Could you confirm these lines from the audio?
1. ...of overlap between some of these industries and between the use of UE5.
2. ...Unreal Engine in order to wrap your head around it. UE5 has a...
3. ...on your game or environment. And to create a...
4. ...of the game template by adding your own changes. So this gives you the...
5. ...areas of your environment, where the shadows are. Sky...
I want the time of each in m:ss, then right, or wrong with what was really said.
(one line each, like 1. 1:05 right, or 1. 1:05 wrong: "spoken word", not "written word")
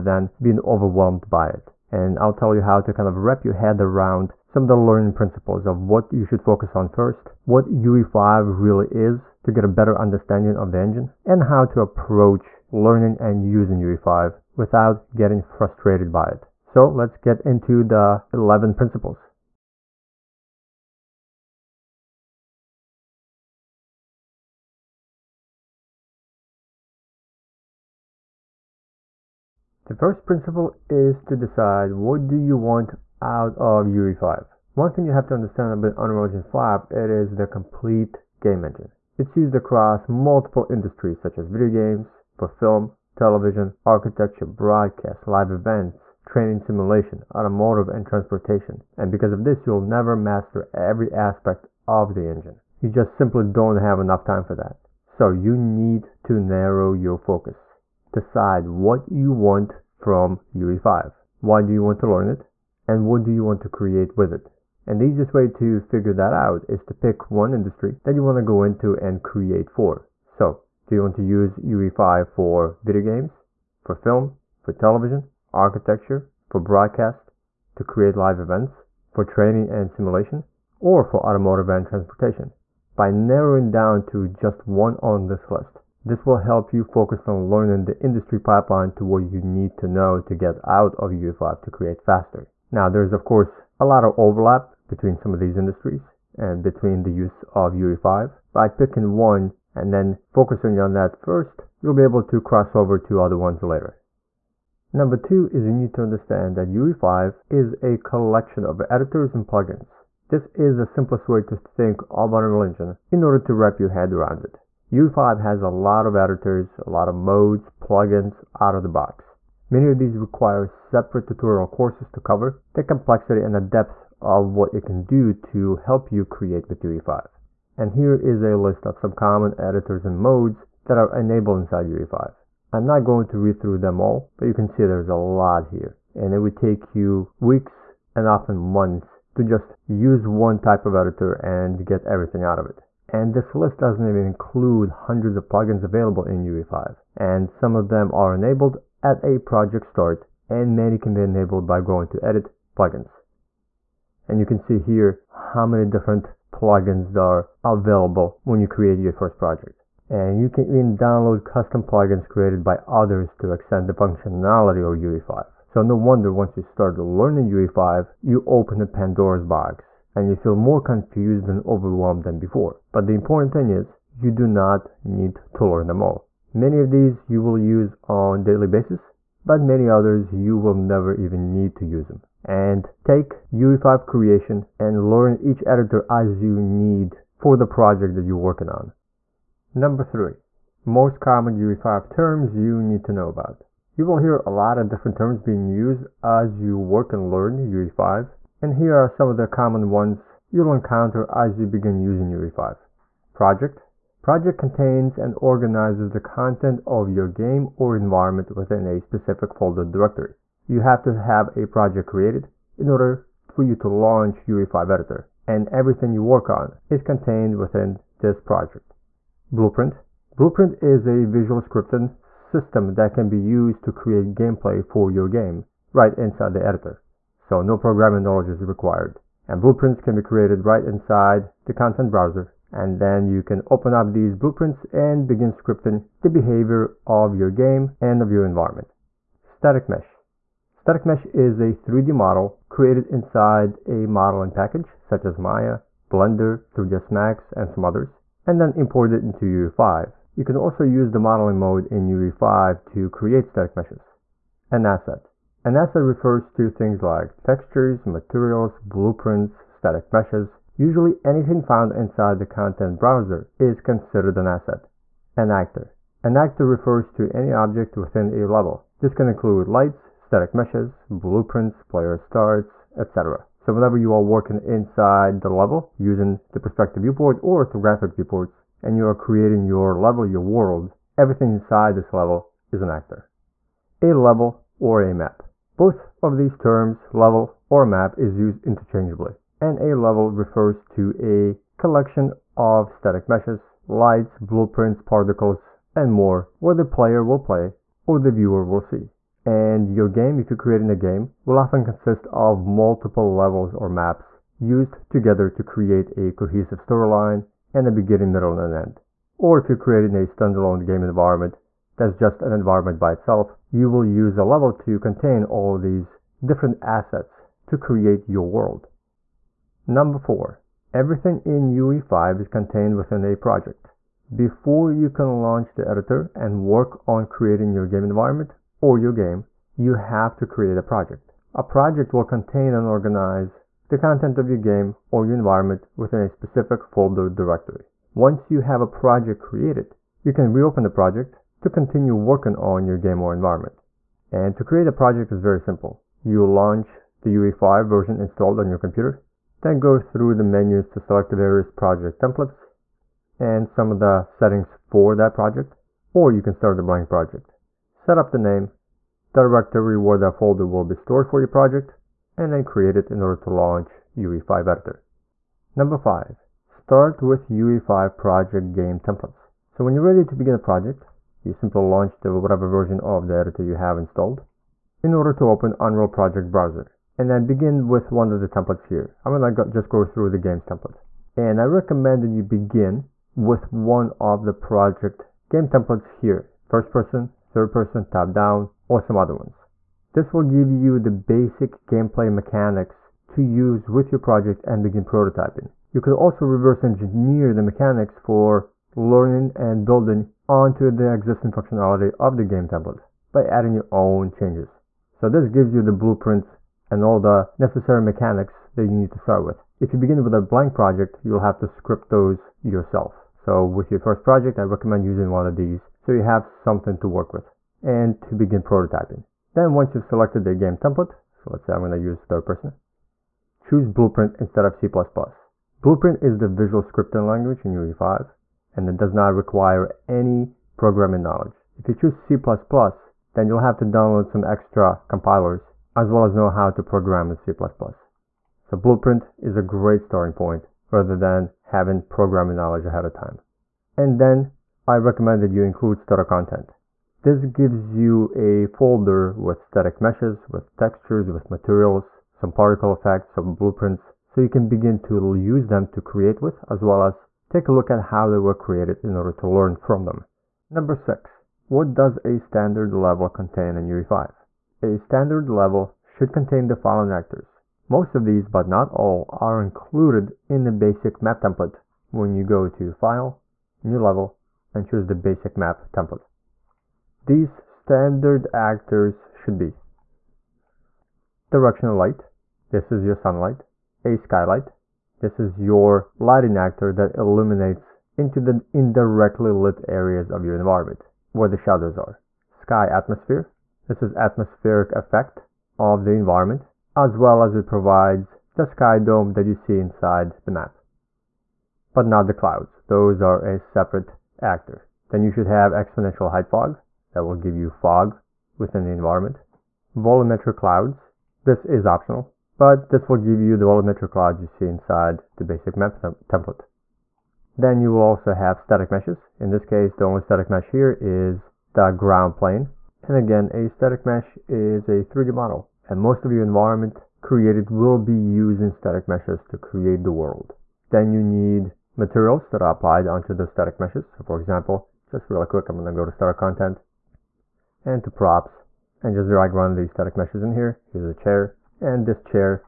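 1. 1:34 right
2. 1:52 right
3. 5:42 right
4. 6:42 right
5. 8:09 right.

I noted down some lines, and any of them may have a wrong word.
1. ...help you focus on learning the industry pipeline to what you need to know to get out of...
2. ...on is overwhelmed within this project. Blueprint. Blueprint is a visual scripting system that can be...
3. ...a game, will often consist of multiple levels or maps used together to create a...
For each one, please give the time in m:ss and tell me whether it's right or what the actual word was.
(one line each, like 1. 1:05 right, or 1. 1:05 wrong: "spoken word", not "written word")
1. 1:26 right
2. 3:36 wrong: "contained", not "overwhelmed"
3. 5:00 right.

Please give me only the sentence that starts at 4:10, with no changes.
You can also use the modeling mode in UE5 to create static meshes.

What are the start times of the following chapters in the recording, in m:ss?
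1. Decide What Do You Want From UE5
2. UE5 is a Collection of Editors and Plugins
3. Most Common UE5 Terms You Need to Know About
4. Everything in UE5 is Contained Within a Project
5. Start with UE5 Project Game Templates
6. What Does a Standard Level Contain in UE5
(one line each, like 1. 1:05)
1. 0:28
2. 1:43
3. 3:08
4. 5:18
5. 6:04
6. 7:39.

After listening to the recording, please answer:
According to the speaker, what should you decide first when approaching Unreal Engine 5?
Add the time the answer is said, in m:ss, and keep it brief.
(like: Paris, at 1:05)
What you want out of UE5, at 0:31.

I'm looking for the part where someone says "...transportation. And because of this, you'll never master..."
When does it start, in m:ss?
0:48.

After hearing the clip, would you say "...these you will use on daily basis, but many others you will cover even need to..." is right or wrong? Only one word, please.
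wrong.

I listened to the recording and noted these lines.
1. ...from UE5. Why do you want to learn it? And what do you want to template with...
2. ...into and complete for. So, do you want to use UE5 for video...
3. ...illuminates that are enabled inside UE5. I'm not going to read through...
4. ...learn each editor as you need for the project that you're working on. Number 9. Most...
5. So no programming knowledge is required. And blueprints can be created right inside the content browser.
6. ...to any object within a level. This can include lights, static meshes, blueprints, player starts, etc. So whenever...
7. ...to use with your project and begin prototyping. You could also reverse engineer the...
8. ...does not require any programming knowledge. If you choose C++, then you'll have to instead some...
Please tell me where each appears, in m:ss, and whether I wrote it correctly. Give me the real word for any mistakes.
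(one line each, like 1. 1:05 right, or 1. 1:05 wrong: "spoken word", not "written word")
1. 0:59 wrong: "create", not "template"
2. 1:08 wrong: "create", not "complete"
3. 2:10 wrong: "modes", not "illuminates"
4. 3:05 wrong: "3", not "9"
5. 3:47 right
6. 4:27 right
7. 6:33 right
8. 7:08 wrong: "download", not "instead".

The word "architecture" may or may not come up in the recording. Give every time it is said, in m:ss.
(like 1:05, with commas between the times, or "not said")
0:43, 1:15.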